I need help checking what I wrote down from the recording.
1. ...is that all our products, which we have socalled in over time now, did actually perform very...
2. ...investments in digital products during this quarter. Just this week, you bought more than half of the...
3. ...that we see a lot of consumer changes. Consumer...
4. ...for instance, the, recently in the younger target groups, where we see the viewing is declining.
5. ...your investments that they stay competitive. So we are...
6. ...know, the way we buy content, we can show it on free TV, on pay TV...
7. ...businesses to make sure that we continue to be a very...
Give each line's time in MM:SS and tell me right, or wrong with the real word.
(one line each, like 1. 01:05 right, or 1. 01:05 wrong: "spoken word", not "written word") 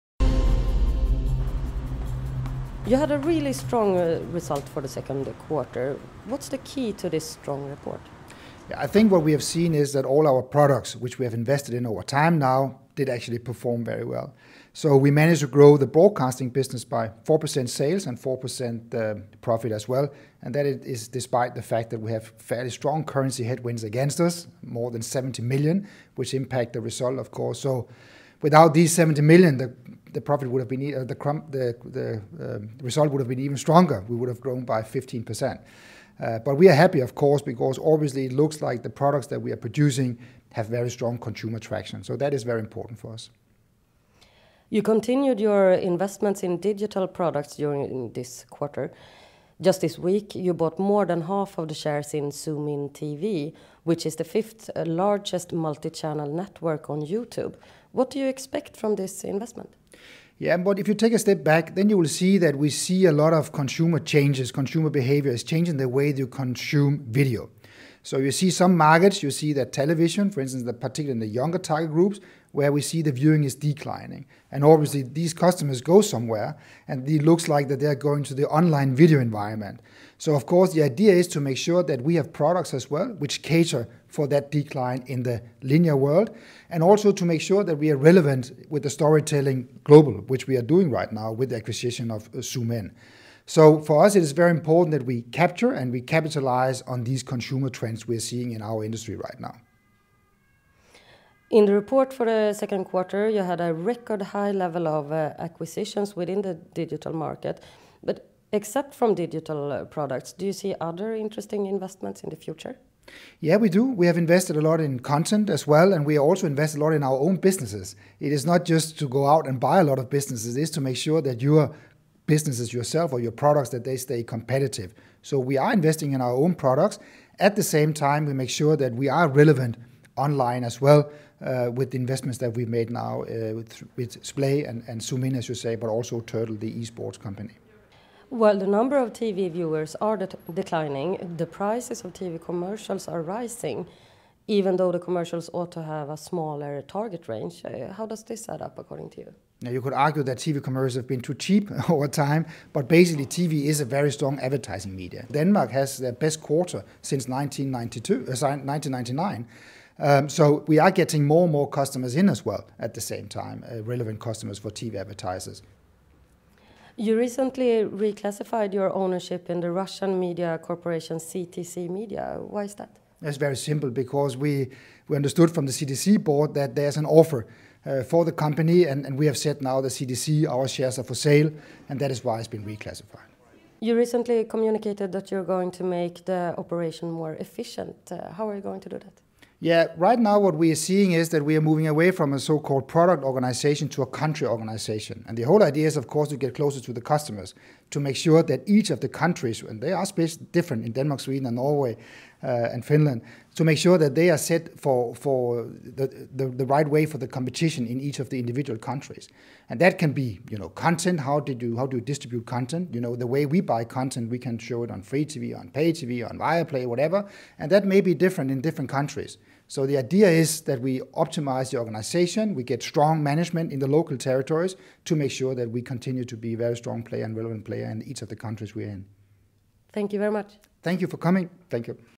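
1. 00:09 wrong: "invested", not "socalled"
2. 00:45 right
3. 01:02 right
4. 01:10 wrong: "particularly", not "recently"
5. 02:03 wrong: "products", not "investments"
6. 03:33 right
7. 03:44 wrong: "territories", not "businesses".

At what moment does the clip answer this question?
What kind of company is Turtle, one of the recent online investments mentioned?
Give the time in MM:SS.
02:16.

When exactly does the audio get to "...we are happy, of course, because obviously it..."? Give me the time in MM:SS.
00:36.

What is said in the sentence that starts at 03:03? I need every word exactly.
You recently communicated that you're going to make the operation more efficient.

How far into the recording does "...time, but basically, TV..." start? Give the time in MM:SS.
02:32.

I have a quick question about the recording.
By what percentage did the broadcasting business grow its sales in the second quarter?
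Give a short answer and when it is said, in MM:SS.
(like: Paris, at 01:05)
4%, at 00:17.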